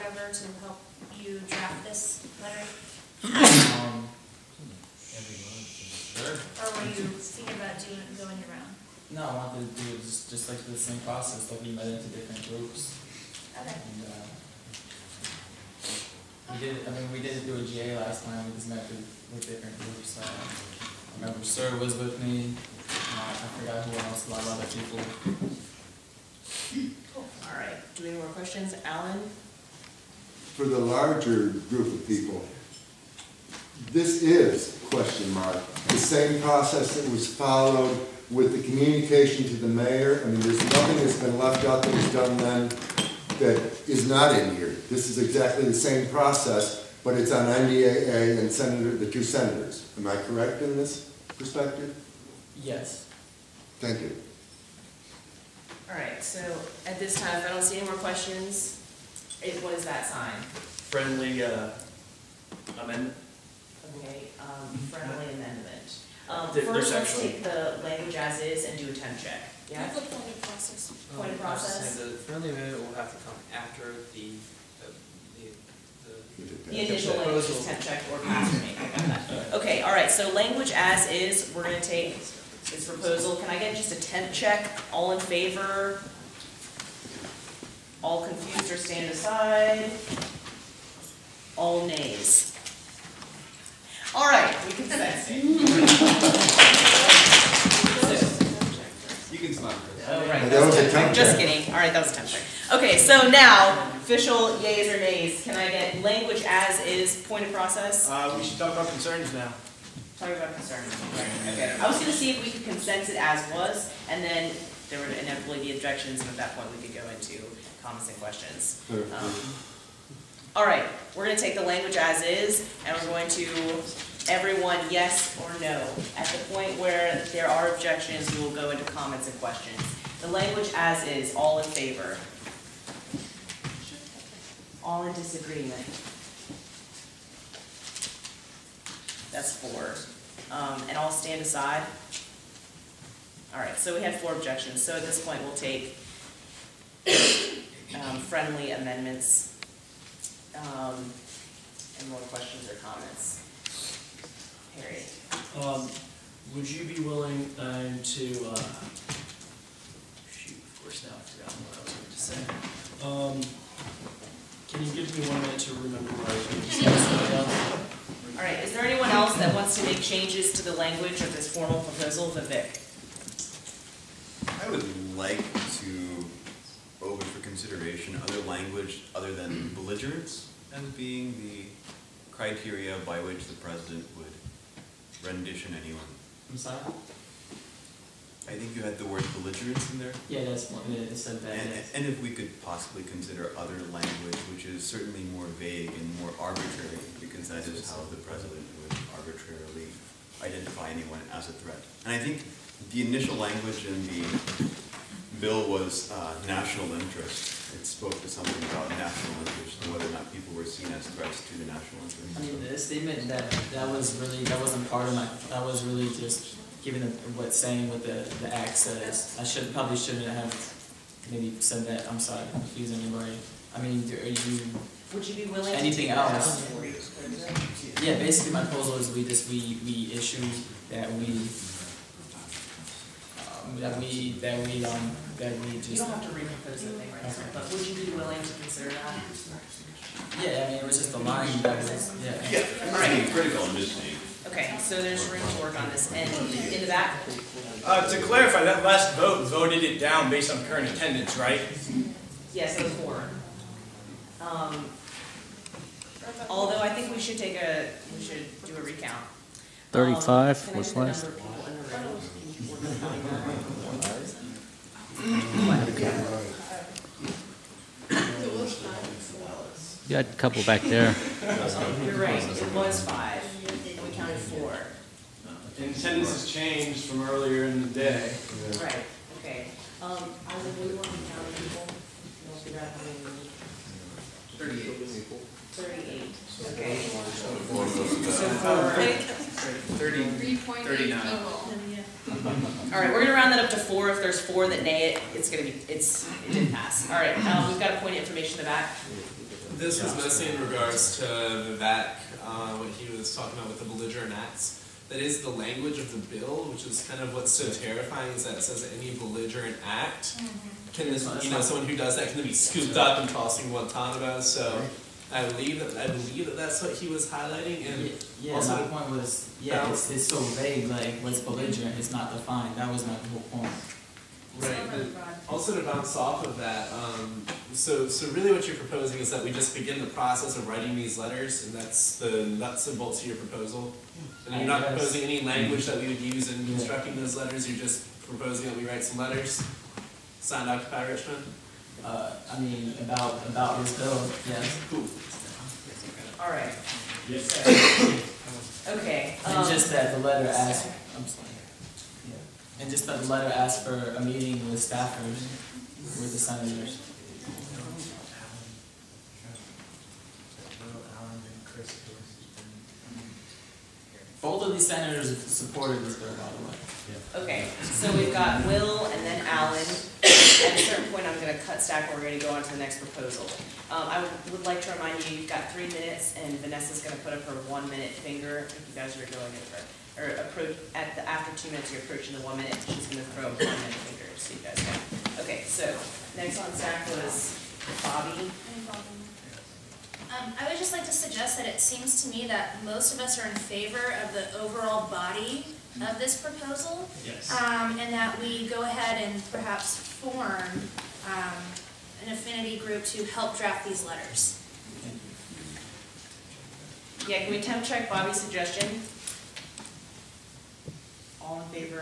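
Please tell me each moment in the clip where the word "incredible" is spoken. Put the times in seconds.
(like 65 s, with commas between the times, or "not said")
not said.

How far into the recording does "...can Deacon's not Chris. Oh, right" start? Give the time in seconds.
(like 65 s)
94 s.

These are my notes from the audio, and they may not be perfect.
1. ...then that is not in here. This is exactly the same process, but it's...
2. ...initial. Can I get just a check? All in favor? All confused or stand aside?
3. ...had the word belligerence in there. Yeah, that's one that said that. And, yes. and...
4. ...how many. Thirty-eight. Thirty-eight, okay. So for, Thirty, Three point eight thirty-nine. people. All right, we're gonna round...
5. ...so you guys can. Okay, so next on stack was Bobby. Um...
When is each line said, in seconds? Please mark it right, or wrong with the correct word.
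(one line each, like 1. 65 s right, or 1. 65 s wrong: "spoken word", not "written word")
1. 42 s right
2. 82 s wrong: "proposal", not "initial"
3. 188 s right
4. 282 s right
5. 384 s right.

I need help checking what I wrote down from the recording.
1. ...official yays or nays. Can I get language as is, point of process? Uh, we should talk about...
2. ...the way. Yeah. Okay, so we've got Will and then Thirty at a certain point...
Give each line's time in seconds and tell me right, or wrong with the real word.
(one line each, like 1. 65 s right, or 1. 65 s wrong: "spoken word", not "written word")
1. 103 s right
2. 366 s wrong: "Allen", not "Thirty".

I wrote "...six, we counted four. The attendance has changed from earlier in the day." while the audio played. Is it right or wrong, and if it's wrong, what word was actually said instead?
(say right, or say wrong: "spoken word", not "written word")
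wrong: "five", not "six".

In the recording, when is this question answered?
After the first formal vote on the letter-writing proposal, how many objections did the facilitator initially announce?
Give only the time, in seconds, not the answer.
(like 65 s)
139 s.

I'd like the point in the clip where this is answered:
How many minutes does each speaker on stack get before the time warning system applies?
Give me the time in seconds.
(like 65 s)
375 s.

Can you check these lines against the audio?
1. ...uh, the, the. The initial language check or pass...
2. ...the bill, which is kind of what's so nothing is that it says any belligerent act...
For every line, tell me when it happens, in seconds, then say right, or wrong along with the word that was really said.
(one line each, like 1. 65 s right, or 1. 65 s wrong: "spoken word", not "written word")
1. 74 s right
2. 306 s wrong: "terrifying", not "nothing".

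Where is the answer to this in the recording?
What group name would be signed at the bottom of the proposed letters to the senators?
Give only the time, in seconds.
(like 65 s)
340 s.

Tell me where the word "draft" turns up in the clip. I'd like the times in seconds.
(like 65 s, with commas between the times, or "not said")
1 s, 403 s.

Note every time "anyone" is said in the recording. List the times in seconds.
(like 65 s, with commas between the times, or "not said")
168 s, 185 s, 200 s.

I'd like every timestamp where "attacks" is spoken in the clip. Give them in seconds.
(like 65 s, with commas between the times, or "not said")
not said.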